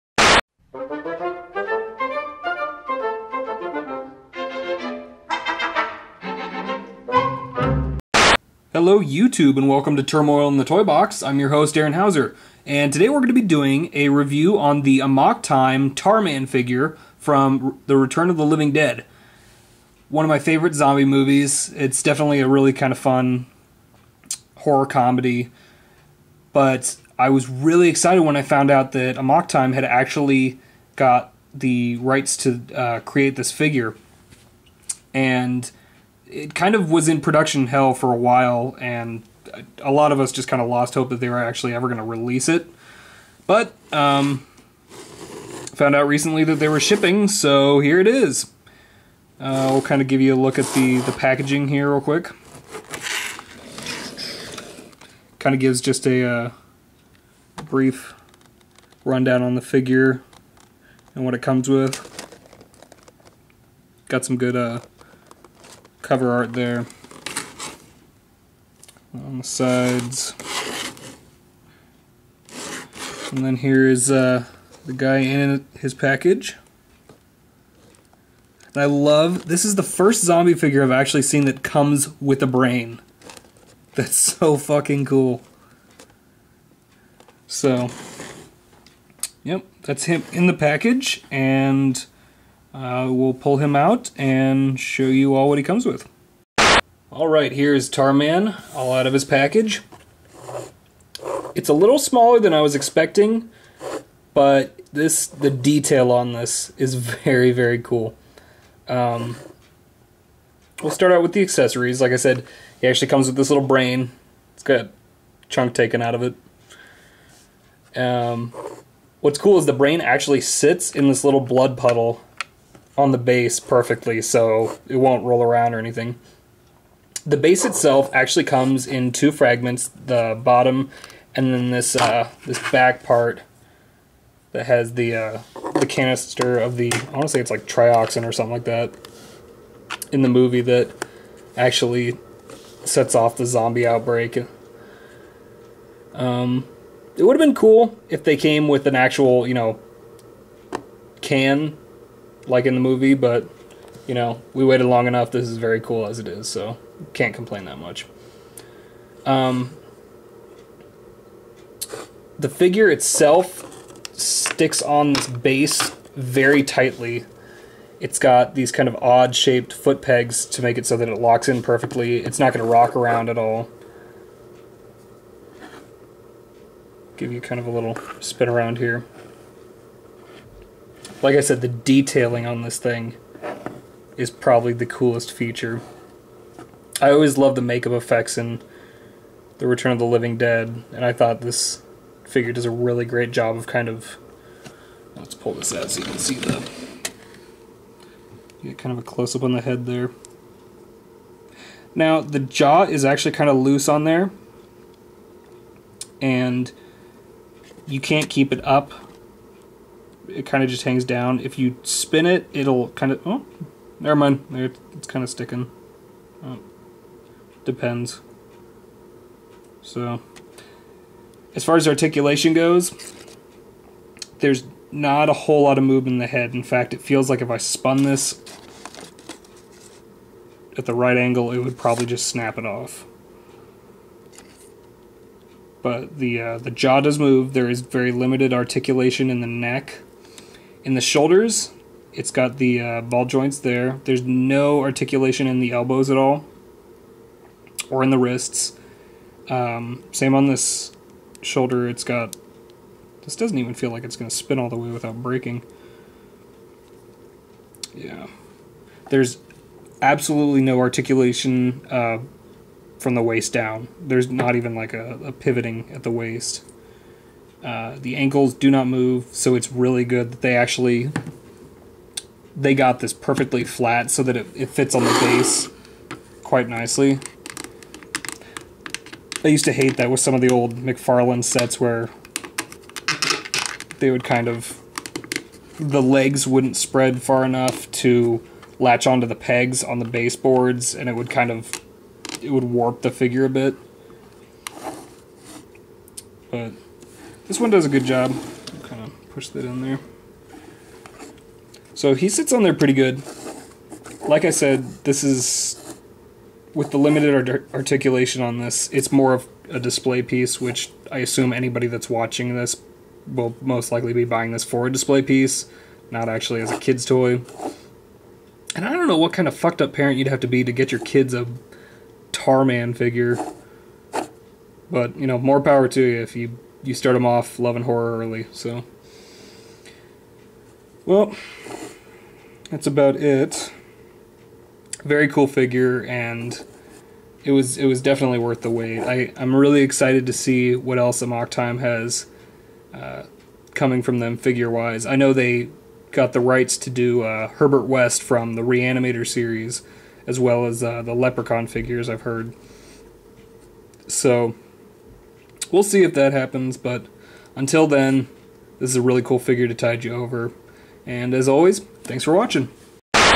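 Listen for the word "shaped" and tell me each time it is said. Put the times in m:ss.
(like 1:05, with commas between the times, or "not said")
2:49.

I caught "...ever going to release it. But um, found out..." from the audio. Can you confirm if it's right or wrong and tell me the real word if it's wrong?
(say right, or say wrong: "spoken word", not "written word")
right.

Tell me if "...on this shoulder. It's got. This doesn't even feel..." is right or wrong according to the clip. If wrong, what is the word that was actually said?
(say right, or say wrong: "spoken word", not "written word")
right.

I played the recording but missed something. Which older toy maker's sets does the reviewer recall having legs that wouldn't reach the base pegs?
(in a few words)
McFarlane.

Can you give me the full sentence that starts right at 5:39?
I I'm really excited to see what else Amok Time has uh, coming from them figure wise.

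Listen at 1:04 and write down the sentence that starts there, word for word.
Got some good uh, cover art there.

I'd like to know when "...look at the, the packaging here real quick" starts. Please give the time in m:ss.
0:50.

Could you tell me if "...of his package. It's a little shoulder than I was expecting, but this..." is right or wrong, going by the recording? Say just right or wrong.
wrong.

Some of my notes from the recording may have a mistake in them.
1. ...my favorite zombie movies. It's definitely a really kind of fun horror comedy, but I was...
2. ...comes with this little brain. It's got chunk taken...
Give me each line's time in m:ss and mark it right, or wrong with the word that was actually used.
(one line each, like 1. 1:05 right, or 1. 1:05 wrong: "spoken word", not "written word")
1. 0:20 right
2. 1:53 right.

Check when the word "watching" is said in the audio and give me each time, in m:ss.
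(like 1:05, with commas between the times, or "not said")
5:12, 6:02.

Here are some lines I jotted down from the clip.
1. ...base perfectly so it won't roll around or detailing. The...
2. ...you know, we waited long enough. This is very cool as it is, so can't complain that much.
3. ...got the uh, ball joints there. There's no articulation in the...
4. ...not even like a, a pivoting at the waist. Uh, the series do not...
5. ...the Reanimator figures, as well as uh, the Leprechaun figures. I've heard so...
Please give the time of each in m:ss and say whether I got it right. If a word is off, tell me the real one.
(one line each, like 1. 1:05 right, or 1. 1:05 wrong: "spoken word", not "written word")
1. 2:03 wrong: "anything", not "detailing"
2. 2:34 right
3. 4:02 right
4. 4:24 wrong: "ankles", not "series"
5. 5:48 wrong: "series", not "figures".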